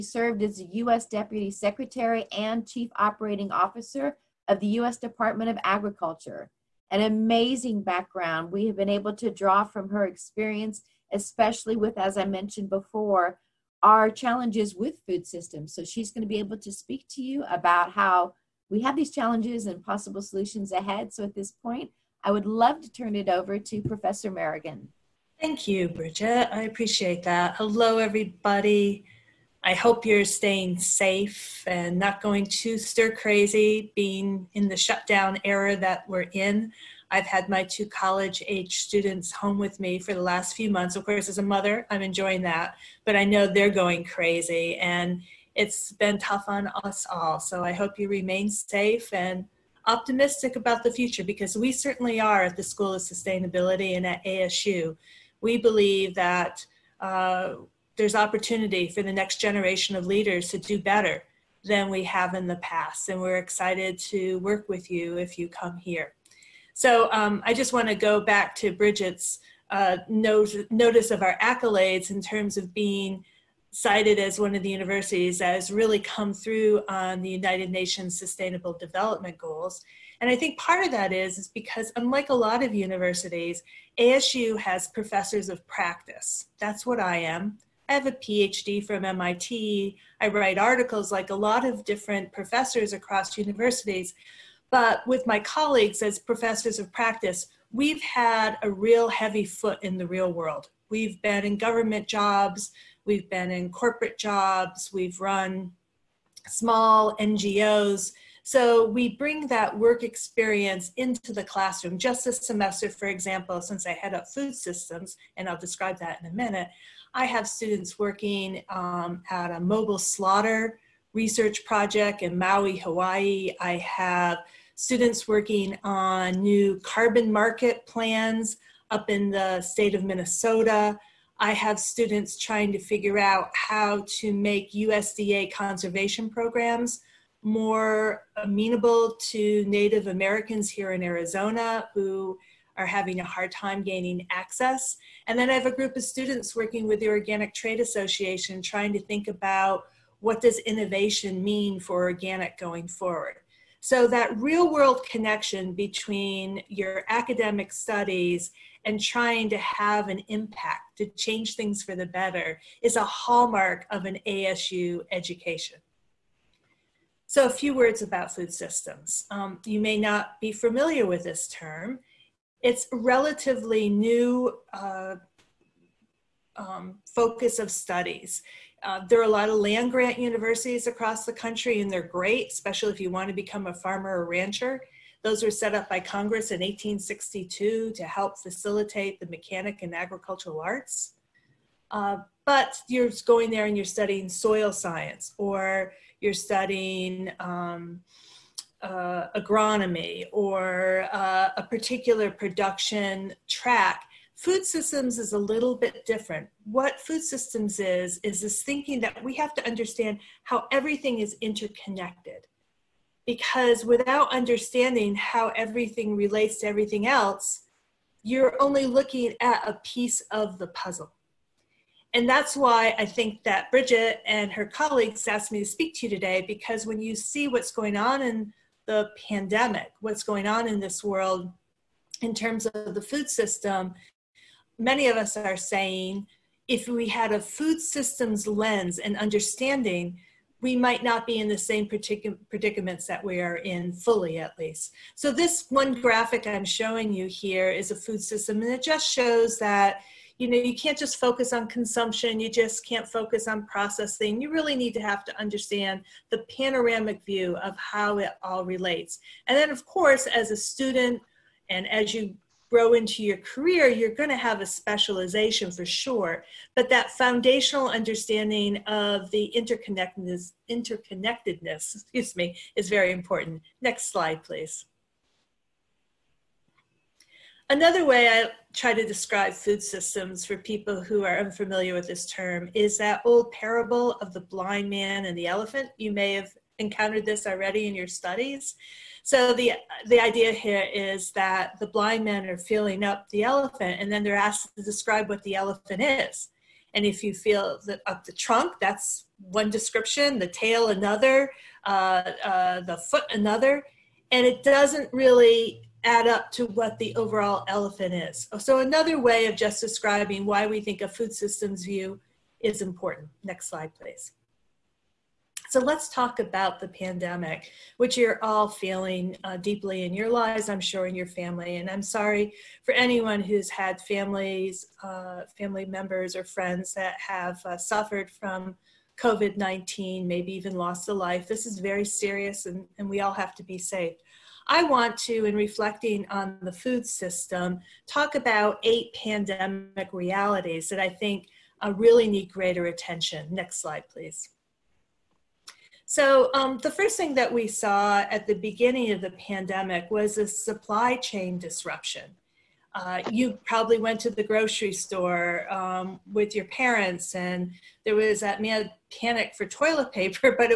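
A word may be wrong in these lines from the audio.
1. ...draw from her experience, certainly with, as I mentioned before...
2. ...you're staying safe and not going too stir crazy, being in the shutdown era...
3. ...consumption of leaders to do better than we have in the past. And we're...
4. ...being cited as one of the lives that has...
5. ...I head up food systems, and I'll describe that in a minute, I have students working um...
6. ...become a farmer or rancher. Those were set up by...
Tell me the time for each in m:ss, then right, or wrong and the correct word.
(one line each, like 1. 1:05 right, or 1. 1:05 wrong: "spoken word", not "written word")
1. 0:09 wrong: "especially", not "certainly"
2. 0:30 right
3. 0:59 wrong: "generation", not "consumption"
4. 1:12 wrong: "universities", not "lives"
5. 1:53 right
6. 3:03 right.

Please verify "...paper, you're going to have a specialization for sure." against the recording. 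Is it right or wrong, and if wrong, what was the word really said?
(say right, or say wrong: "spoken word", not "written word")
wrong: "career", not "paper".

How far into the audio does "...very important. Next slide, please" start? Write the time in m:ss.
4:32.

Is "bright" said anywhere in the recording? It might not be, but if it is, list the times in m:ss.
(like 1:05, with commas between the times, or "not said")
not said.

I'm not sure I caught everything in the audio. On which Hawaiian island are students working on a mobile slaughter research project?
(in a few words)
Maui.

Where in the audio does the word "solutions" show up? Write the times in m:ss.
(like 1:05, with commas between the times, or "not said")
0:20.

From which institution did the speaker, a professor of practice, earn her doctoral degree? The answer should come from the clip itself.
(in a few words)
MIT.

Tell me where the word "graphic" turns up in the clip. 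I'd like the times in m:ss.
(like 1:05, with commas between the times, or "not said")
4:06.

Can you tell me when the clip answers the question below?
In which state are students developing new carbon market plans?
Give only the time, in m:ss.
2:10.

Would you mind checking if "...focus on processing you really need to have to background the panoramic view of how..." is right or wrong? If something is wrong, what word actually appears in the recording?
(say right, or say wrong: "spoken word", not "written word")
wrong: "understand", not "background".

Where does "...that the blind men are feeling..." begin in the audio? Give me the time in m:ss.
4:51.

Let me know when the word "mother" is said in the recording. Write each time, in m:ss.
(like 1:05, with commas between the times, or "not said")
0:41.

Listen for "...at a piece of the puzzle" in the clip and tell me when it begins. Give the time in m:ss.
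3:39.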